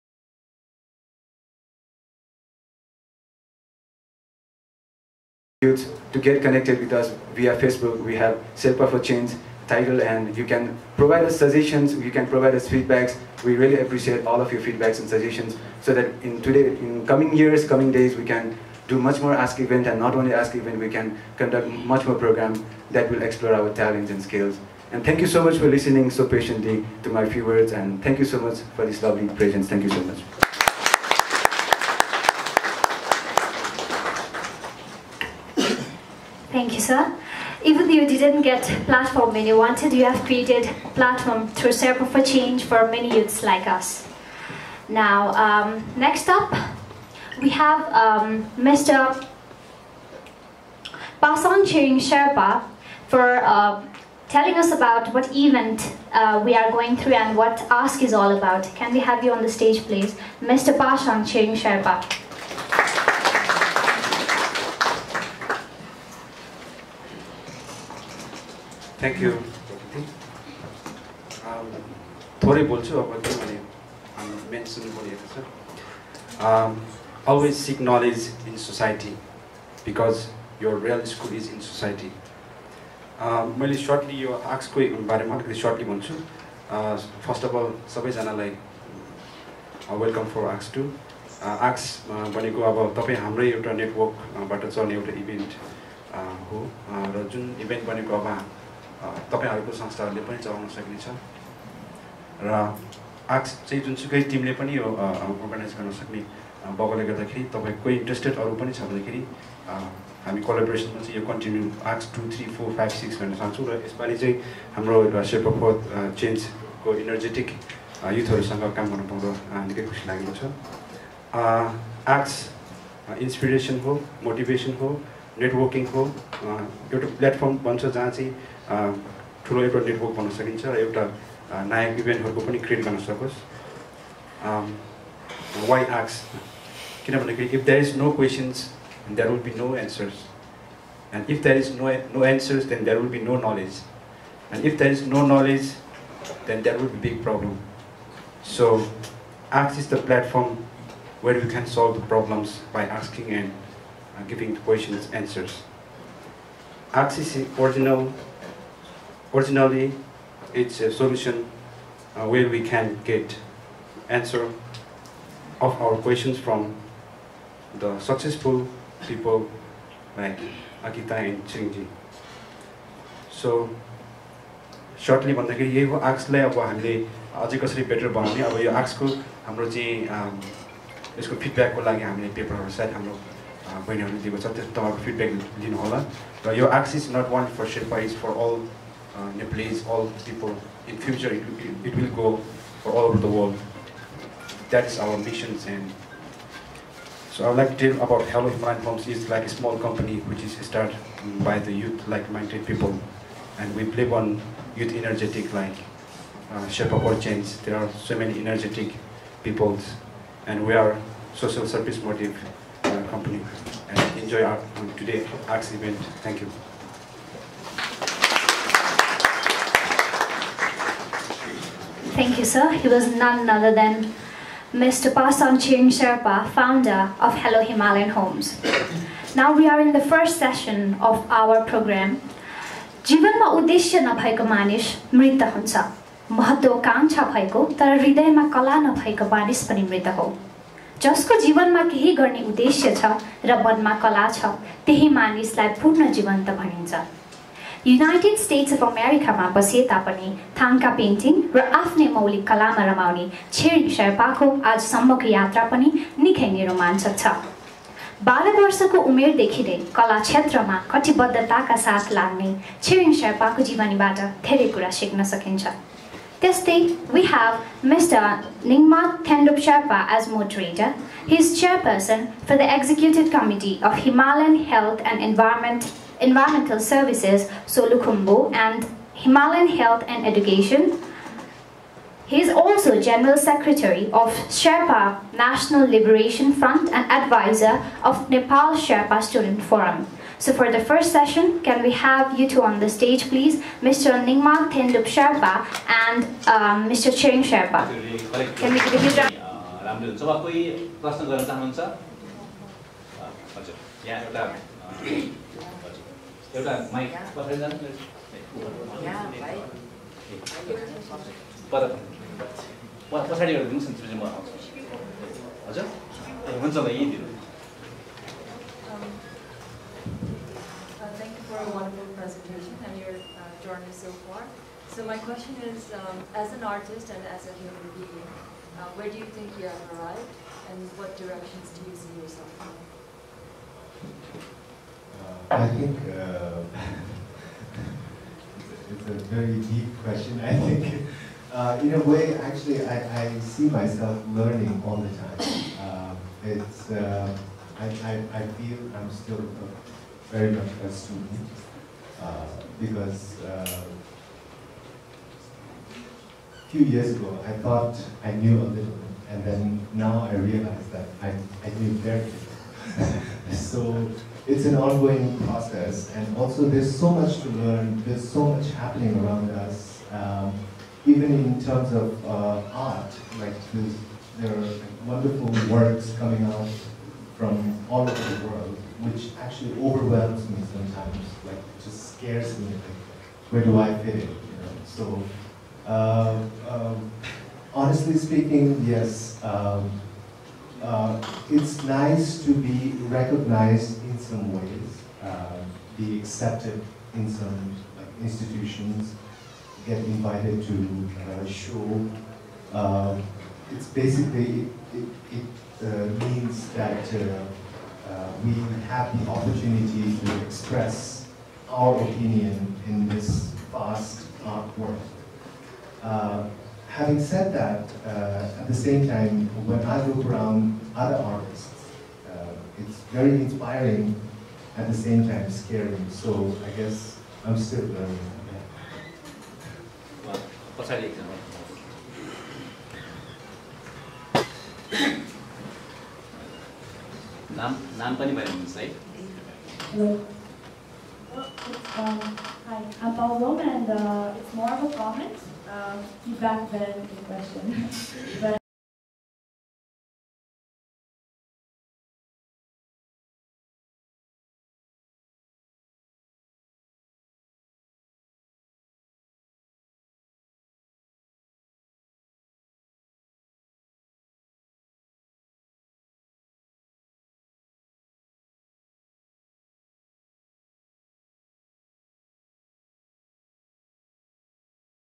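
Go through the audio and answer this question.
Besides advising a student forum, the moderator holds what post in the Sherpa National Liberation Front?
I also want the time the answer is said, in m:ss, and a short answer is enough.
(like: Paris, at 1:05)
General Secretary, at 4:43.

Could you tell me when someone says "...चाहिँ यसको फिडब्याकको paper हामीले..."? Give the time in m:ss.
2:59.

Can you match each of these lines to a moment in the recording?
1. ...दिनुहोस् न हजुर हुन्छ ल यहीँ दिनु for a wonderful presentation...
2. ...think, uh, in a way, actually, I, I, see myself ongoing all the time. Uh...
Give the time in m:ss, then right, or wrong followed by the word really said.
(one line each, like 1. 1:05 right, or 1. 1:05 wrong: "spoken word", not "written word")
1. 5:13 right
2. 5:40 wrong: "learning", not "ongoing".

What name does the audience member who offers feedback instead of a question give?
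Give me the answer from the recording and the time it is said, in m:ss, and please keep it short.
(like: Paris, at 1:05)
Paul Bowman, at 7:23.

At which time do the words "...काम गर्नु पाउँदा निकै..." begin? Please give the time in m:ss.
1:58.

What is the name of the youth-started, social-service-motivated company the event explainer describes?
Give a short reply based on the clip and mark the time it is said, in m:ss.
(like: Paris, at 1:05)
Hello Human, at 3:18.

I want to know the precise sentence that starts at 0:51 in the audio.
Basan Ching Sherpa for uh, telling us about what event uh, we are going through and what Ask is all about.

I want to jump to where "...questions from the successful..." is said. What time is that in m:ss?
2:45.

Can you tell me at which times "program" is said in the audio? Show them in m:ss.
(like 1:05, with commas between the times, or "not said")
0:22, 3:51.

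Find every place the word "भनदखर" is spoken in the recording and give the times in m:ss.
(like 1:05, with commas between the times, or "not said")
1:48, 2:17, 2:55.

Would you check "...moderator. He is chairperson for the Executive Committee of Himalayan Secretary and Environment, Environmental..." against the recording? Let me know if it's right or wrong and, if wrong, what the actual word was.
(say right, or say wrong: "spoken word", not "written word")
wrong: "Health", not "Secretary".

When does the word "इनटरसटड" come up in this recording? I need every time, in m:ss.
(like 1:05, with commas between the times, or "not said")
1:48.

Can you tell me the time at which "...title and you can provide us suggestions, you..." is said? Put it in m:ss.
0:09.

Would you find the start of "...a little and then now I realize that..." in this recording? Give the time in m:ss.
5:58.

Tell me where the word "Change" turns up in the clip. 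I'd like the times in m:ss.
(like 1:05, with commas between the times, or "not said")
0:08, 0:42, 3:27.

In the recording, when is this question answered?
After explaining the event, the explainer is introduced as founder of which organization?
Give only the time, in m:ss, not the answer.
3:47.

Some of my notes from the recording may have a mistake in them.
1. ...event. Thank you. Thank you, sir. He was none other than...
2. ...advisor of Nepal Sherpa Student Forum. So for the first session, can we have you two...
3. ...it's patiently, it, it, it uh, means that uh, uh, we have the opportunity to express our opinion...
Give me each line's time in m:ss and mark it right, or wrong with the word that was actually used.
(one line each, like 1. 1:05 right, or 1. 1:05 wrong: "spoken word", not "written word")
1. 3:35 right
2. 4:47 right
3. 6:43 wrong: "basically", not "patiently".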